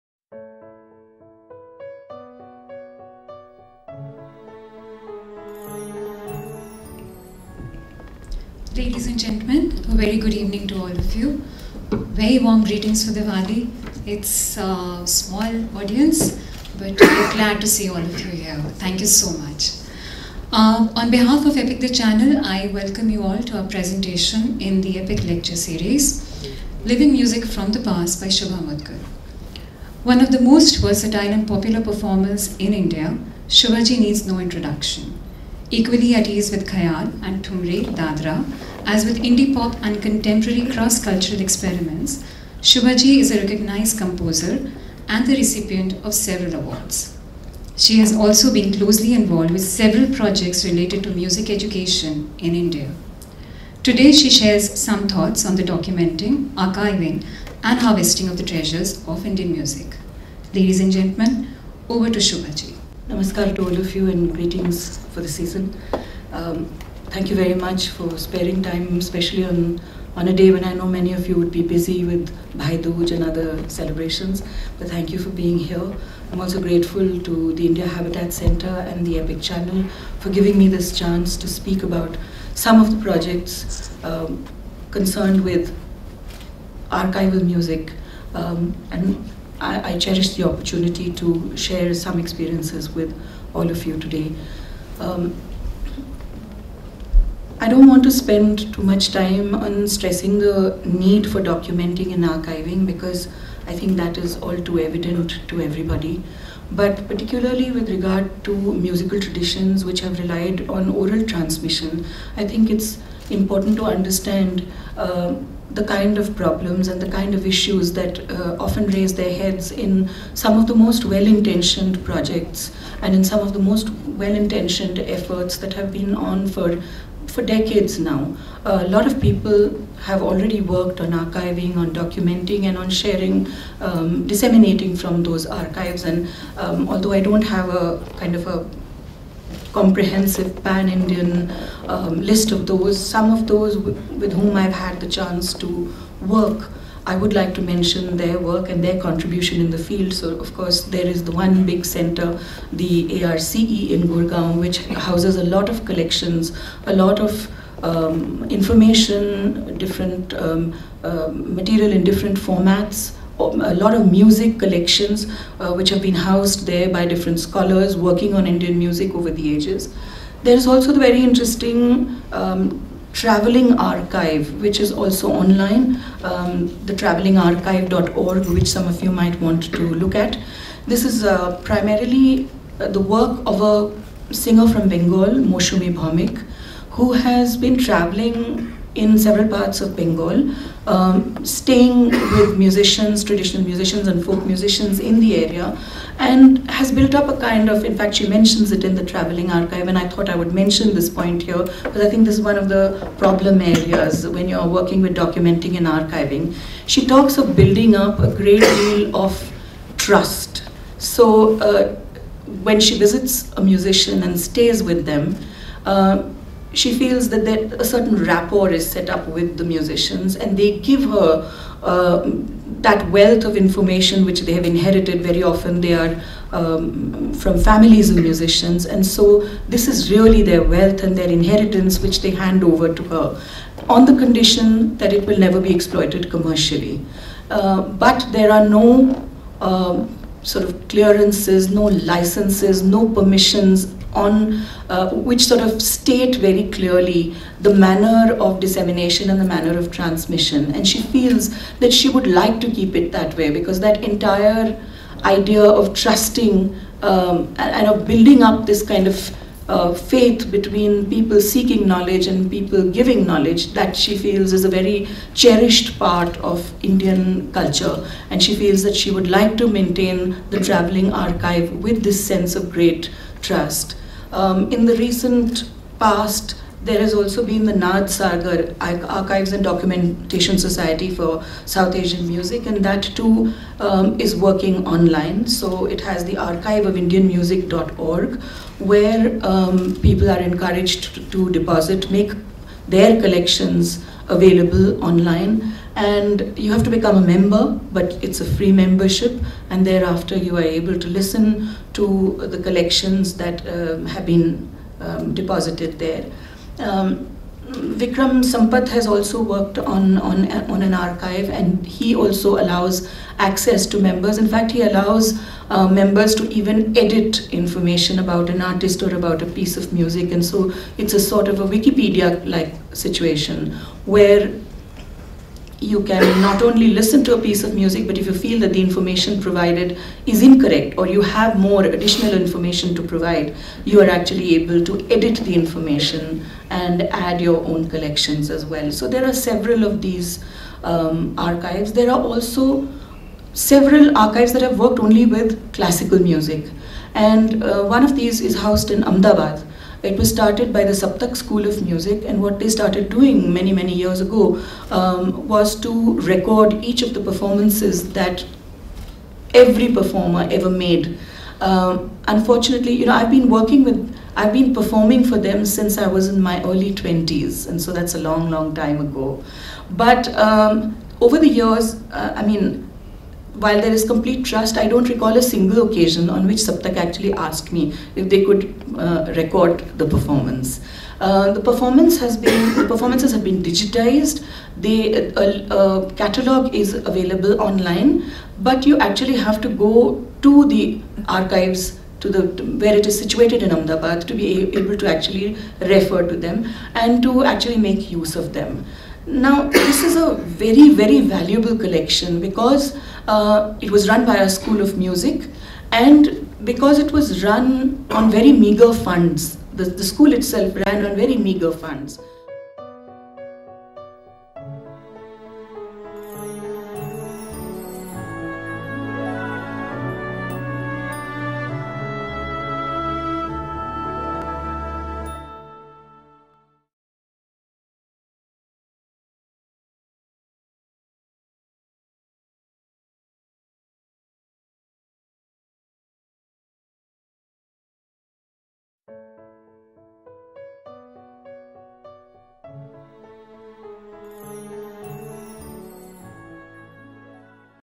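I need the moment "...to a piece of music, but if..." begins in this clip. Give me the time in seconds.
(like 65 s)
327 s.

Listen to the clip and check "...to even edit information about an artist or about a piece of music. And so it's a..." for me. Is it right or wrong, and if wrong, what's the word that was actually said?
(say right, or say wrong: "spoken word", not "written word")
right.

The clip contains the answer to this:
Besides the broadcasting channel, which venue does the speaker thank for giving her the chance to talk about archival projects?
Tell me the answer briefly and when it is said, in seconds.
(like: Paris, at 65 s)
India Habitat Center, at 77 s.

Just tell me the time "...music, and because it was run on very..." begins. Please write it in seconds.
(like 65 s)
404 s.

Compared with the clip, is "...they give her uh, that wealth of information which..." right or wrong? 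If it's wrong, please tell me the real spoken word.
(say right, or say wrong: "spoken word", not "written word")
right.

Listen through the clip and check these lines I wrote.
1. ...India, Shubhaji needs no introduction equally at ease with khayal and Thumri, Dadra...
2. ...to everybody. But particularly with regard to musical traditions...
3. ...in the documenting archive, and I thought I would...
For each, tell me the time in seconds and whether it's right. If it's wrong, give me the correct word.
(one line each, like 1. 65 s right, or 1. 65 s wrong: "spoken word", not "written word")
1. 32 s right
2. 105 s right
3. 198 s wrong: "traveling", not "documenting".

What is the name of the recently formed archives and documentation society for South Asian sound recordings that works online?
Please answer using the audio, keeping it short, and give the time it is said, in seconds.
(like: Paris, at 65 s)
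Nad Sagar, at 277 s.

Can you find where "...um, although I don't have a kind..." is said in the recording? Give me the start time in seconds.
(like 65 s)
136 s.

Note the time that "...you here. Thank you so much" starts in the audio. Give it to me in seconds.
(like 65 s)
18 s.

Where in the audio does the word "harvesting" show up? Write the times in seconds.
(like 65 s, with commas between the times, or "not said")
57 s.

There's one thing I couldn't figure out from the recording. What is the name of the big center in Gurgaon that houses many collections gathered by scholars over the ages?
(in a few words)
ARCE.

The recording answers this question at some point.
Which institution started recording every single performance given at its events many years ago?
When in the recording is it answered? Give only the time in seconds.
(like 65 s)
350 s.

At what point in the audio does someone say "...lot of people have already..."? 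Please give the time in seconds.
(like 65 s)
128 s.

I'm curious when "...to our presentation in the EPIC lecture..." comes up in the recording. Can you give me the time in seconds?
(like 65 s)
23 s.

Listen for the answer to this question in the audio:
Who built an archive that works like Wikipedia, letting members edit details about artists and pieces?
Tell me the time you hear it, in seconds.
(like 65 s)
307 s.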